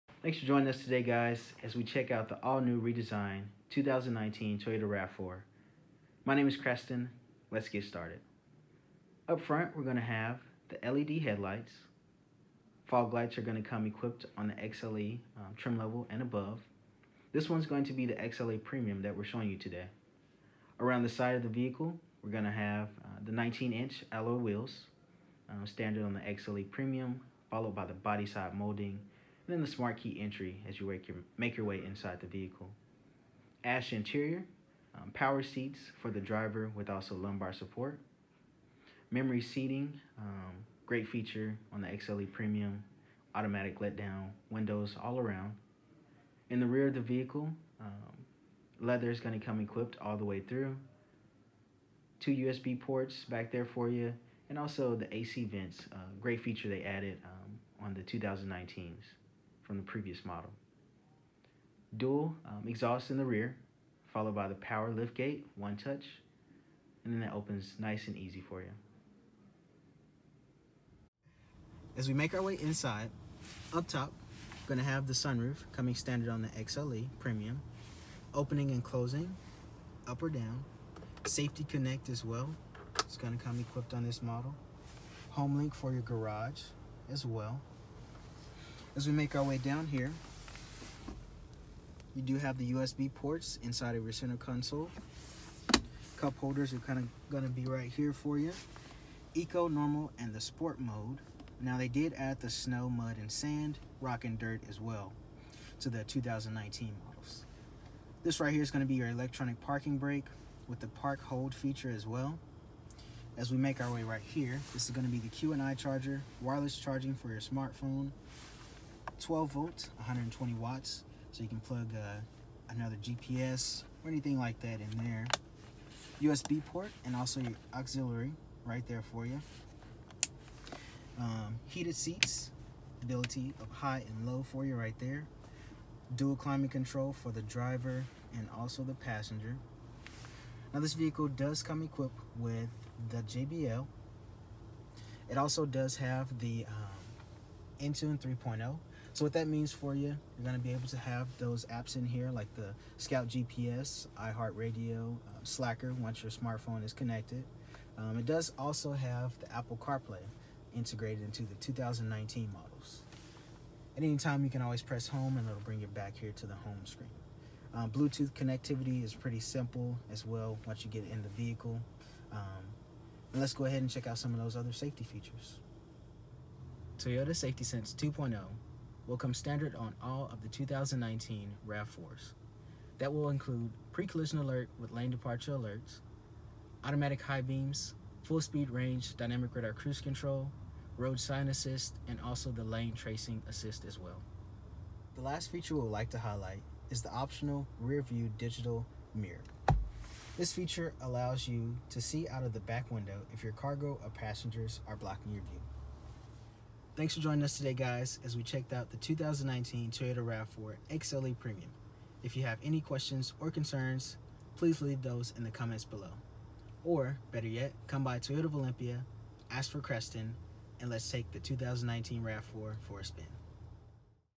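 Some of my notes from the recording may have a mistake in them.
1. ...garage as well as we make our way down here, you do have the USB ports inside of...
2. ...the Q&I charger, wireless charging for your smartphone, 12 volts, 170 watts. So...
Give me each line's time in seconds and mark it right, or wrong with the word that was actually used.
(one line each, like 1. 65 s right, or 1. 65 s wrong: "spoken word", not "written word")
1. 86 s right
2. 115 s wrong: "120", not "170".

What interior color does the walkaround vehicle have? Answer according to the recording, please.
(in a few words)
Ash.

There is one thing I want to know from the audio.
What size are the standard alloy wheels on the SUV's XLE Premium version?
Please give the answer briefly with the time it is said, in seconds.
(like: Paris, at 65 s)
19-inch, at 23 s.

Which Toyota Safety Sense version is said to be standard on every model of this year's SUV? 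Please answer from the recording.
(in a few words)
2.0.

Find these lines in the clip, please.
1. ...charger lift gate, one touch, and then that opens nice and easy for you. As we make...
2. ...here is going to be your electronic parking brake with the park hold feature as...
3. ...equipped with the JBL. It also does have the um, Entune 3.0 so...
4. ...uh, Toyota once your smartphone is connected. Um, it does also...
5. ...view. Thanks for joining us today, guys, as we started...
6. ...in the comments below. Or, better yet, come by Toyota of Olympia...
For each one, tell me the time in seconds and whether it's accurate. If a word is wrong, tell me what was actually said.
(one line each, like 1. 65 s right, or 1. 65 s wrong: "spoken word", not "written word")
1. 64 s wrong: "power", not "charger"
2. 108 s right
3. 141 s right
4. 155 s wrong: "Slacker", not "Toyota"
5. 205 s wrong: "checked", not "started"
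6. 215 s right.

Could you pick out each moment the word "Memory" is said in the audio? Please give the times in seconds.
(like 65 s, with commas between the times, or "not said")
39 s.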